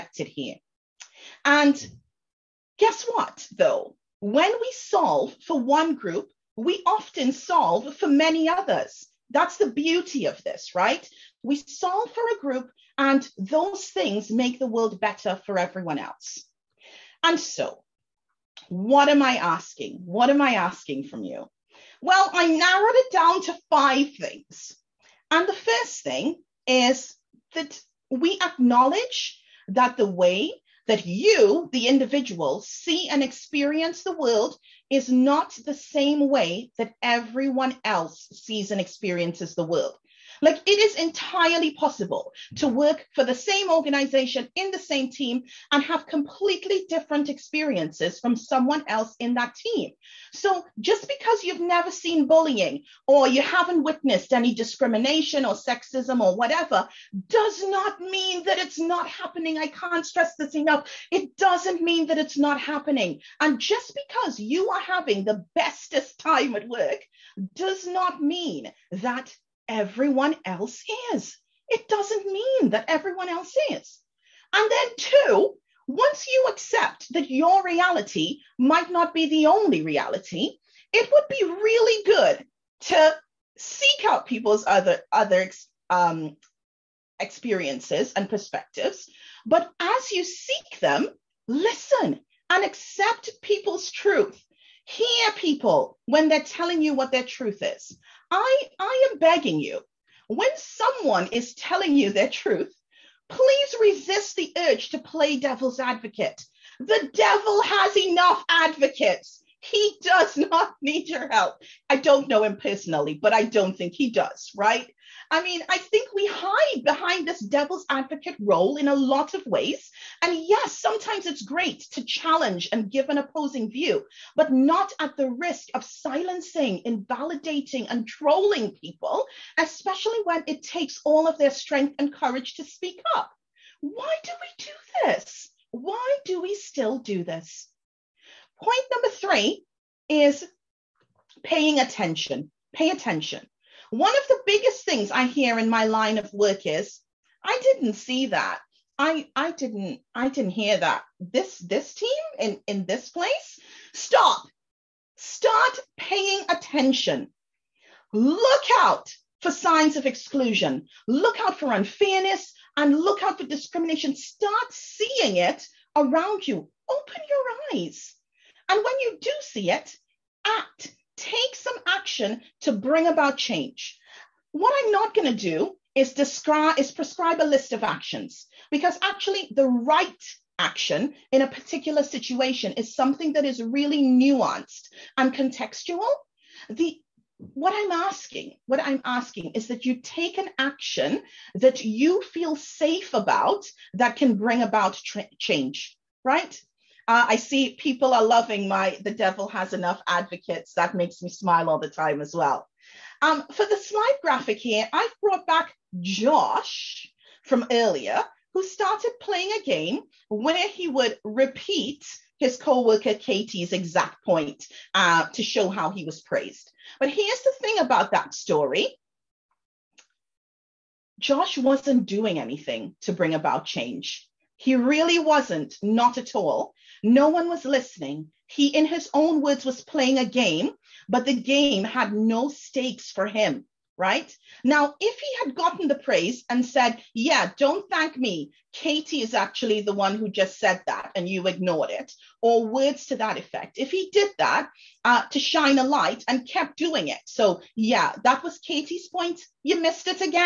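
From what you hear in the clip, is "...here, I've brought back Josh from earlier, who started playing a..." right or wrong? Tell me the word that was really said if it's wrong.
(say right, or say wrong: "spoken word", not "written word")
right.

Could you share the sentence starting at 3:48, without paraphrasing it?
He, in his own words, was playing a game, but the game had no stakes for him right?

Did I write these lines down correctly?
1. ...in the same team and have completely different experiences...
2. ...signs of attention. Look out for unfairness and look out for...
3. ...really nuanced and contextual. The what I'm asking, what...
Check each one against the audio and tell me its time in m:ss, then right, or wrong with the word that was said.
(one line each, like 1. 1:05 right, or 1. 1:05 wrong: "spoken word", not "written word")
1. 0:44 right
2. 2:39 wrong: "exclusion", not "attention"
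3. 3:03 right.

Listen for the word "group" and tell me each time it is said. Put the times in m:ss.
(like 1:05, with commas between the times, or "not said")
0:05, 0:12.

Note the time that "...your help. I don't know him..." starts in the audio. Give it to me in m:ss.
1:51.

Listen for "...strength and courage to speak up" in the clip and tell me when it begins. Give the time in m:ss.
2:11.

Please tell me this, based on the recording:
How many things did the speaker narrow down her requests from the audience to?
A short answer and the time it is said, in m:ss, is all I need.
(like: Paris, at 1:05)
5, at 0:23.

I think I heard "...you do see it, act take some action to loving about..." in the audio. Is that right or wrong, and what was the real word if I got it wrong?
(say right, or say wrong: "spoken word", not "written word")
wrong: "bring", not "loving".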